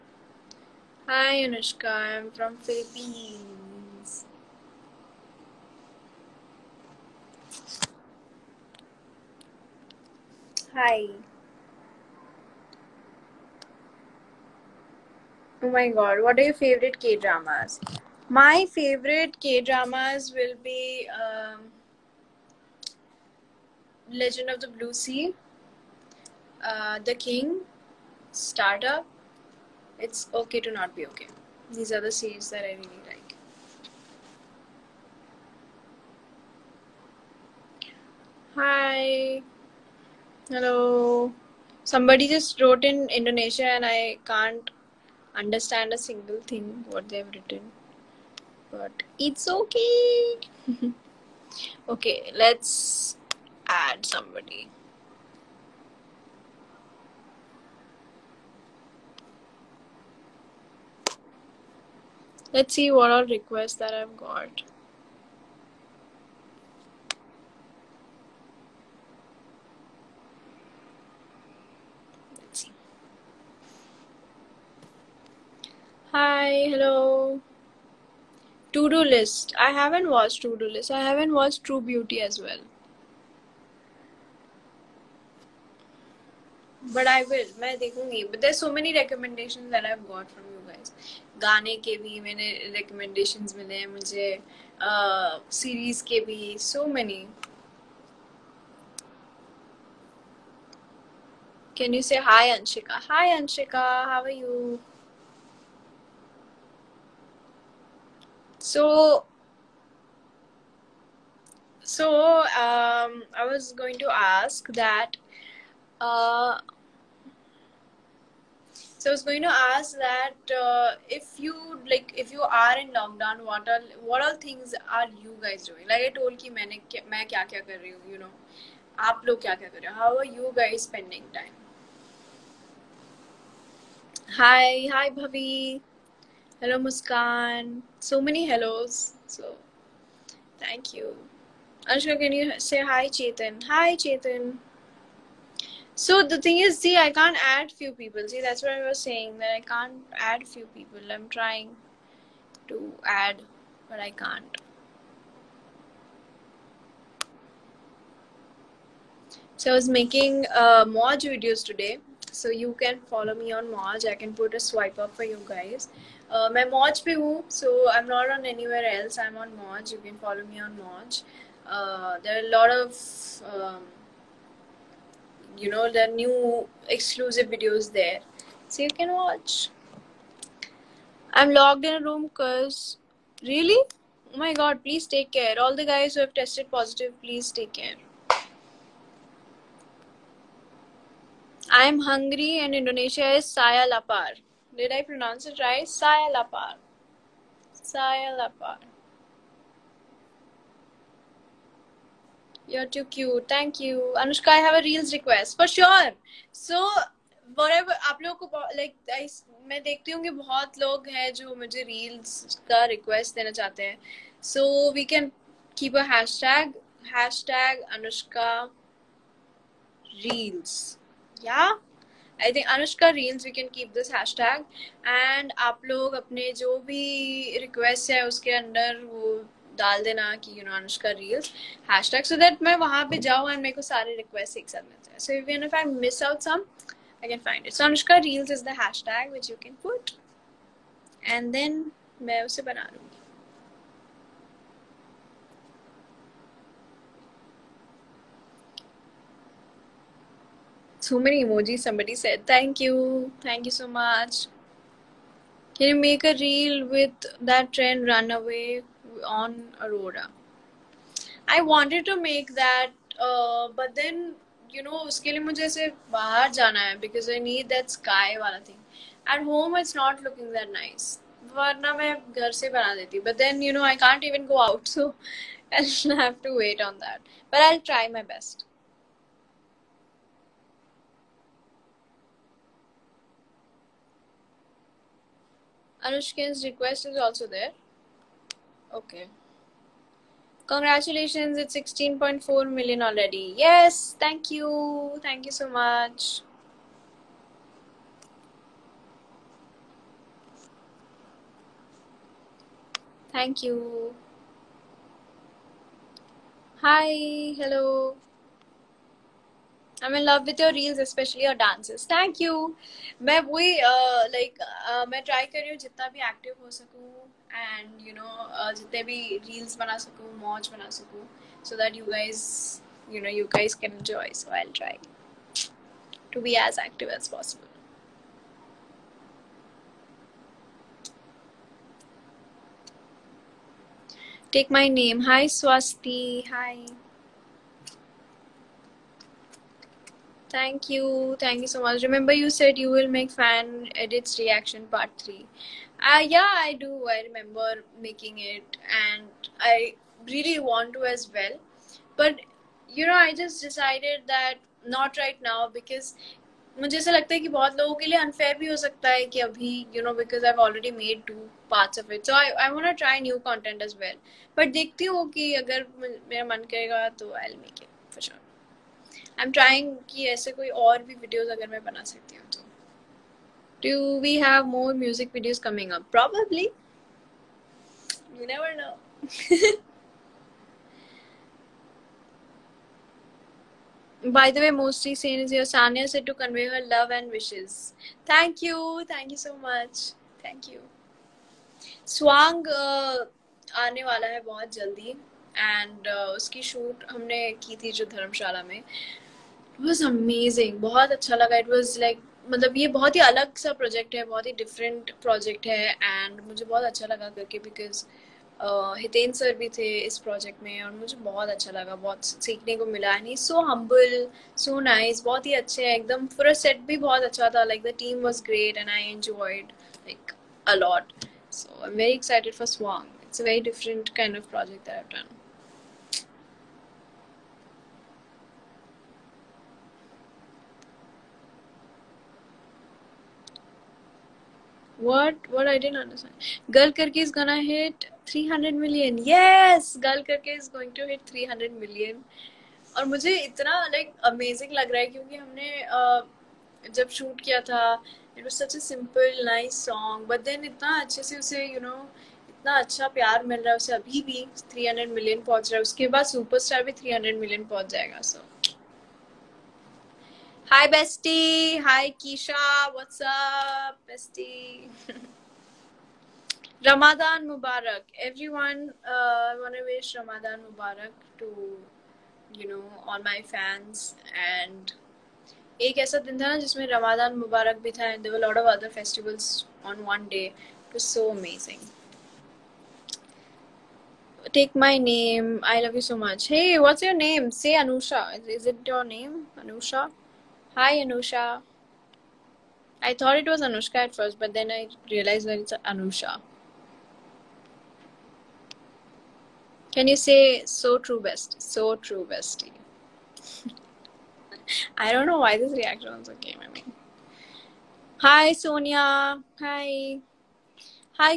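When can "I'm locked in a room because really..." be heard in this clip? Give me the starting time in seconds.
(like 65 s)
181 s.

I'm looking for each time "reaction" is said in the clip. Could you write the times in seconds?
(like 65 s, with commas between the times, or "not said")
344 s, 505 s.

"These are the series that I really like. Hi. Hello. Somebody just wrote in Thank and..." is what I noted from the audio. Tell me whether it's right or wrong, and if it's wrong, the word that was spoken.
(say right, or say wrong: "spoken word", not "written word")
wrong: "Indonesia", not "Thank".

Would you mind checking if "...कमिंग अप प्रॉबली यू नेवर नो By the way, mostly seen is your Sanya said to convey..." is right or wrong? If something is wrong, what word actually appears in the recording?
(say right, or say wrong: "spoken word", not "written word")
right.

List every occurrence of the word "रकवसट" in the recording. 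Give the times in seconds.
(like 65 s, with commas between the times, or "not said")
227 s, 234 s.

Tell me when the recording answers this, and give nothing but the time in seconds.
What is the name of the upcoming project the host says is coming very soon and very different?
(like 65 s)
392 s.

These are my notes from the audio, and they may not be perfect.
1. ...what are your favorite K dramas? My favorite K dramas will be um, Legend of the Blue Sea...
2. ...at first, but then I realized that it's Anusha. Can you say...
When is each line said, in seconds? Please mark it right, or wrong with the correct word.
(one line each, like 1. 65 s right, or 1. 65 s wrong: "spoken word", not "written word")
1. 16 s right
2. 493 s right.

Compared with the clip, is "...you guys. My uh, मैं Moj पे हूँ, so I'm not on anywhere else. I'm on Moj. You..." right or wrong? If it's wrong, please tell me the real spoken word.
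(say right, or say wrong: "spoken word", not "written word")
right.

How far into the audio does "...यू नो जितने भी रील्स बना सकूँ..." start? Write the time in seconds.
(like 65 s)
318 s.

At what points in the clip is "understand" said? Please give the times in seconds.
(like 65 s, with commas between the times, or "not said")
45 s, 435 s.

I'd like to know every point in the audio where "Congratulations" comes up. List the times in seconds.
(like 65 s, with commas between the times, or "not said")
290 s.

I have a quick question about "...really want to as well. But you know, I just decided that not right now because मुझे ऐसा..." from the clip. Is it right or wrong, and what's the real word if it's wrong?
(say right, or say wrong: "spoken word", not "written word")
right.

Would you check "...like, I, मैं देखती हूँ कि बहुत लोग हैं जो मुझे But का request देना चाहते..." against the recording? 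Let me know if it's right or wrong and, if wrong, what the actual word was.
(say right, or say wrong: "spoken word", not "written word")
wrong: "Reels", not "But".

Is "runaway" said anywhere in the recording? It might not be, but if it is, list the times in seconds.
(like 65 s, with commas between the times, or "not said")
258 s.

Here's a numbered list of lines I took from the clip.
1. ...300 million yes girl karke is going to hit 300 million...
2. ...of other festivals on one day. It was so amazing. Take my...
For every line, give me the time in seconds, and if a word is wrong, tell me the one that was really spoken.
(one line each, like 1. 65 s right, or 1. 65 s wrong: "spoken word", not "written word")
1. 438 s right
2. 478 s right.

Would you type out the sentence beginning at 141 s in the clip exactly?
Anushka, can you say hi, Chetan?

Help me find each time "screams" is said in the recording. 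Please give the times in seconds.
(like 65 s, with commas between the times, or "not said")
not said.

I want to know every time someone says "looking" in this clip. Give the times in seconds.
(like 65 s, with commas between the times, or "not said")
270 s.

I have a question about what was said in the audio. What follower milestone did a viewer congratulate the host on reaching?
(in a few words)
16.4 million.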